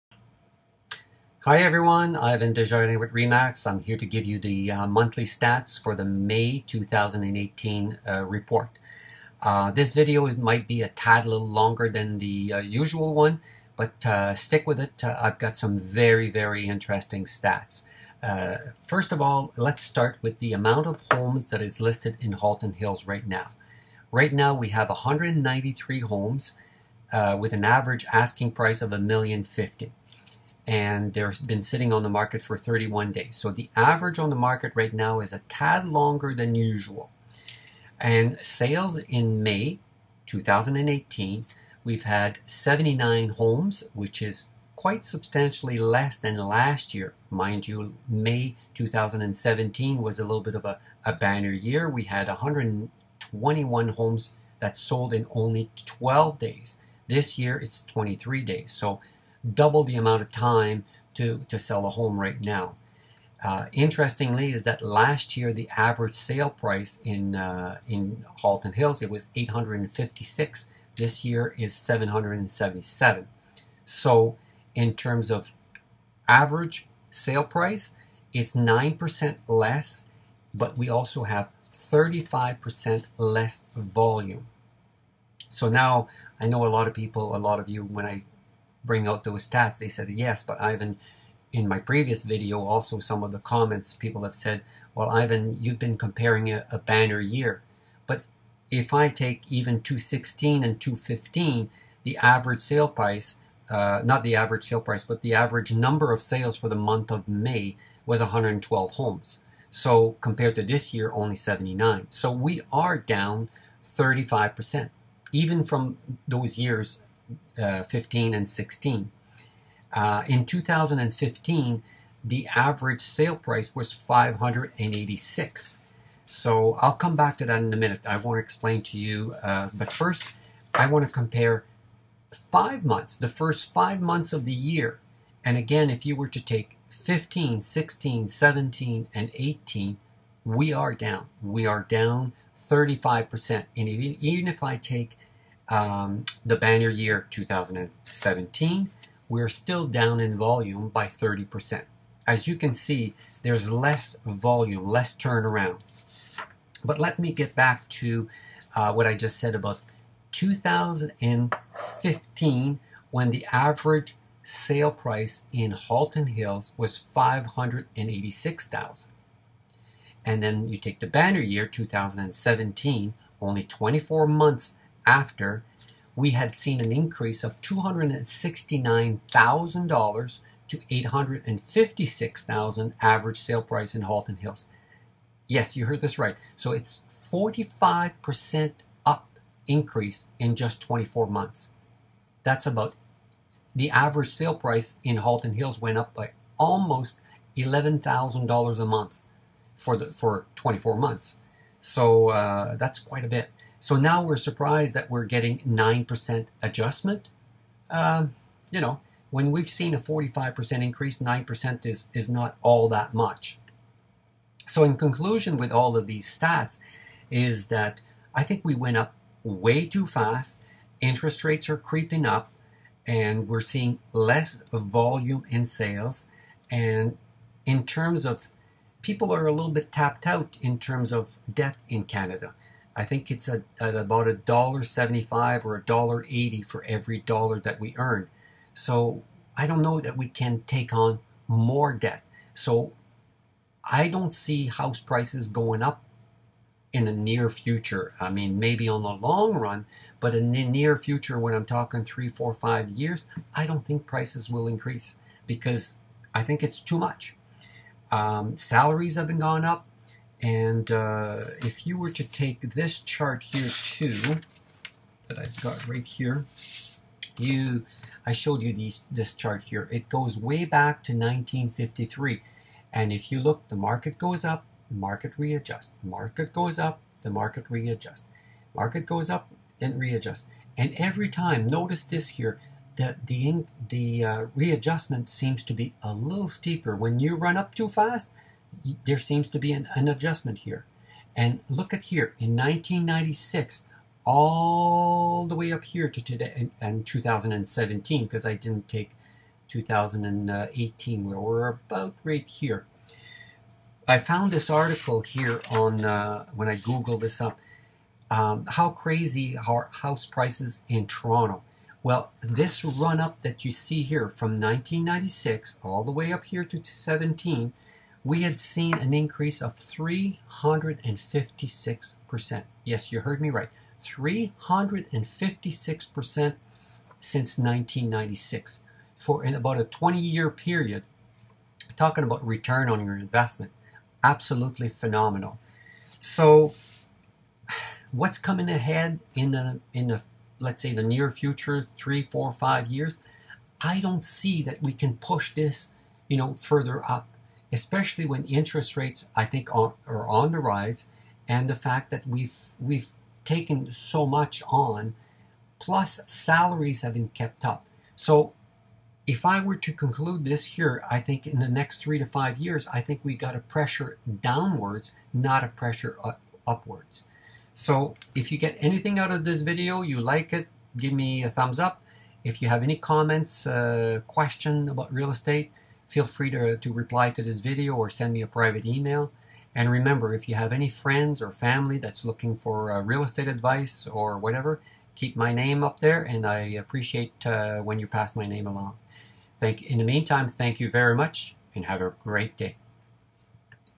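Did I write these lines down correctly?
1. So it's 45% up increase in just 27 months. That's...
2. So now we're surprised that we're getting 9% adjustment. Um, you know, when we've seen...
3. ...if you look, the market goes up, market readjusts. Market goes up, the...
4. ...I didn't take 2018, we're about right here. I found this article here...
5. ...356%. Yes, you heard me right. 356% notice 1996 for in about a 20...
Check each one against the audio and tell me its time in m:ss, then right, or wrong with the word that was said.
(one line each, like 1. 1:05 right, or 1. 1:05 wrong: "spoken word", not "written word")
1. 3:06 wrong: "24", not "27"
2. 3:23 right
3. 4:33 right
4. 4:58 right
5. 5:19 wrong: "since", not "notice".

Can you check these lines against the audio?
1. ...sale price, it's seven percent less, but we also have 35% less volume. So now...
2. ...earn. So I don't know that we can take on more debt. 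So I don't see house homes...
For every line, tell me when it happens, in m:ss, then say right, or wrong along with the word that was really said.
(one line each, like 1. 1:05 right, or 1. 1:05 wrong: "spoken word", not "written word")
1. 1:17 wrong: "nine", not "seven"
2. 3:57 wrong: "prices", not "homes".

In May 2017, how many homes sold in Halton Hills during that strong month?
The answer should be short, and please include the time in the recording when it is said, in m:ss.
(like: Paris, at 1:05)
121, at 0:52.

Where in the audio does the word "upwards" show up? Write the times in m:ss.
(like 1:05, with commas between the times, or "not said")
6:06.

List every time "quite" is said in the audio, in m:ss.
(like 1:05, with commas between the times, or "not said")
0:44, 3:22.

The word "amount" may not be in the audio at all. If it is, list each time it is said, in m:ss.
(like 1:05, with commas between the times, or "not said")
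0:20, 0:59.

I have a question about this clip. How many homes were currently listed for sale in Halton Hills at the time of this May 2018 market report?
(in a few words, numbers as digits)
193.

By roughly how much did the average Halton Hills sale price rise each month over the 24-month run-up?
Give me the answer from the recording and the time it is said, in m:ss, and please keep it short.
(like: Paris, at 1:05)
$11,000, at 3:17.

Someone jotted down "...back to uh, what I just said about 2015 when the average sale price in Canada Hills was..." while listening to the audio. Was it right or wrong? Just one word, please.
wrong.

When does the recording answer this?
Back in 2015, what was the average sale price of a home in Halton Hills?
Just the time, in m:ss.
2:03.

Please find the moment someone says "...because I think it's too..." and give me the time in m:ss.
4:15.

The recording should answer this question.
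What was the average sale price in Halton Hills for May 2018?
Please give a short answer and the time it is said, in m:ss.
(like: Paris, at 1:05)
777, at 1:11.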